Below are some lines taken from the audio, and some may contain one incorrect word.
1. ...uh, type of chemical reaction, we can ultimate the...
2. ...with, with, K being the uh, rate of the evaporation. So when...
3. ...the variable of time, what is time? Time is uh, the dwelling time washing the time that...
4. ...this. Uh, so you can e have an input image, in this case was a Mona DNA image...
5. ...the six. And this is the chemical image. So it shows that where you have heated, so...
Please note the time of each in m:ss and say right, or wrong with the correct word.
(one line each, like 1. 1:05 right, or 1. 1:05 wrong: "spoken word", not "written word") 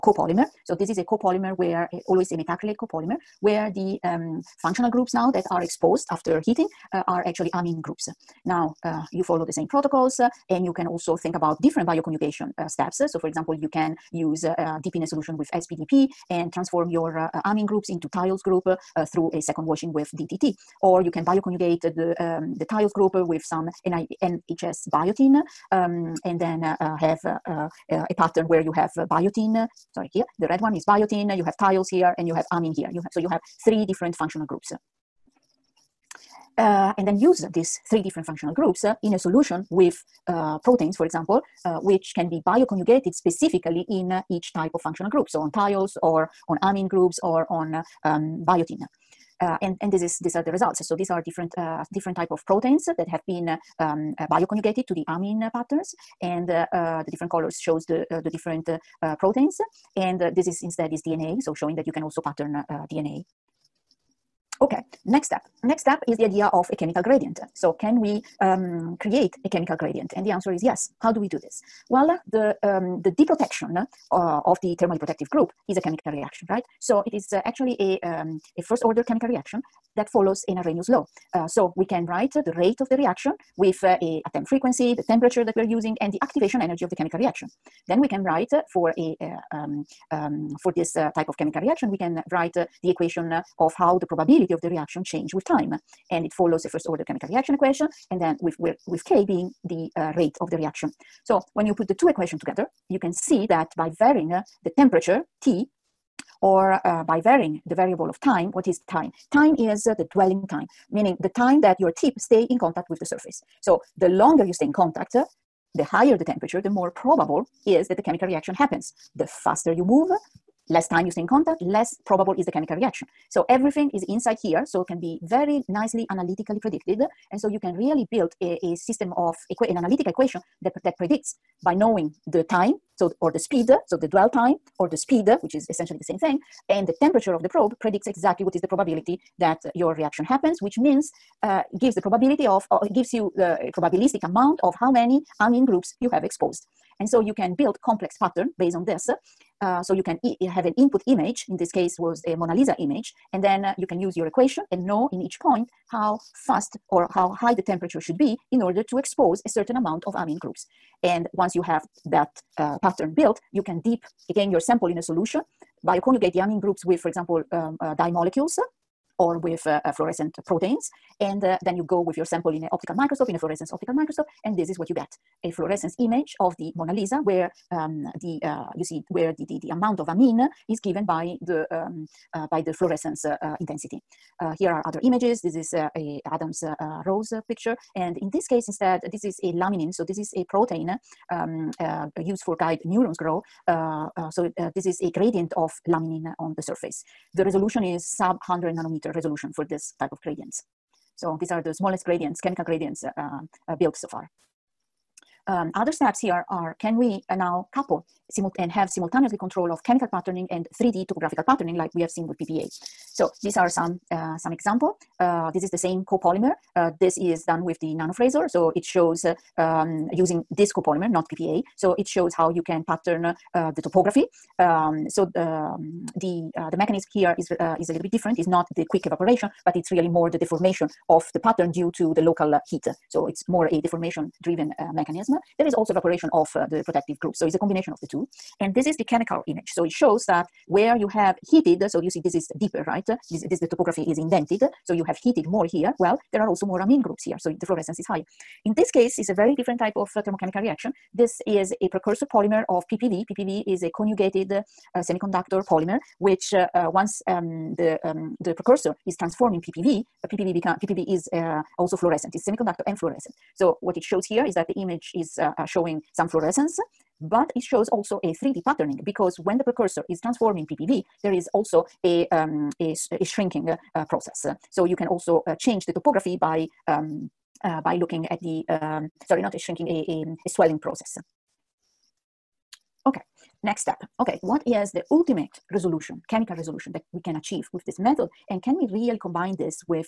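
1. 1:30 wrong: "write", not "ultimate"
2. 1:38 wrong: "reaction", not "evaporation"
3. 1:47 wrong: "meaning", not "washing"
4. 2:28 wrong: "Lisa", not "DNA"
5. 3:58 wrong: "two", not "six".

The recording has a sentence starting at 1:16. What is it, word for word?
So it is uh, actually a, um, a first order chemical reaction that follows an Arrhenius law.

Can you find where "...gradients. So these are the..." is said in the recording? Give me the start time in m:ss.
3:20.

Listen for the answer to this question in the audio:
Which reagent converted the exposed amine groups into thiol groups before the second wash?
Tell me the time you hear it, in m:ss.
0:15.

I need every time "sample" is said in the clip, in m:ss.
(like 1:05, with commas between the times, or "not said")
2:44, 2:52.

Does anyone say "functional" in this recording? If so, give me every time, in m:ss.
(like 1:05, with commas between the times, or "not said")
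0:04, 0:34, 0:38, 0:44.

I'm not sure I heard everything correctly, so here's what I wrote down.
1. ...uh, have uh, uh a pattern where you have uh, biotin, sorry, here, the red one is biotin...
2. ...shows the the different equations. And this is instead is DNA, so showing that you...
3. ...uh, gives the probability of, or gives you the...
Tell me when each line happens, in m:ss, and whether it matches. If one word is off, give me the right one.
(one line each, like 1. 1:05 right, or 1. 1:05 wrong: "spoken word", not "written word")
1. 0:26 right
2. 0:57 wrong: "proteins", not "equations"
3. 2:21 right.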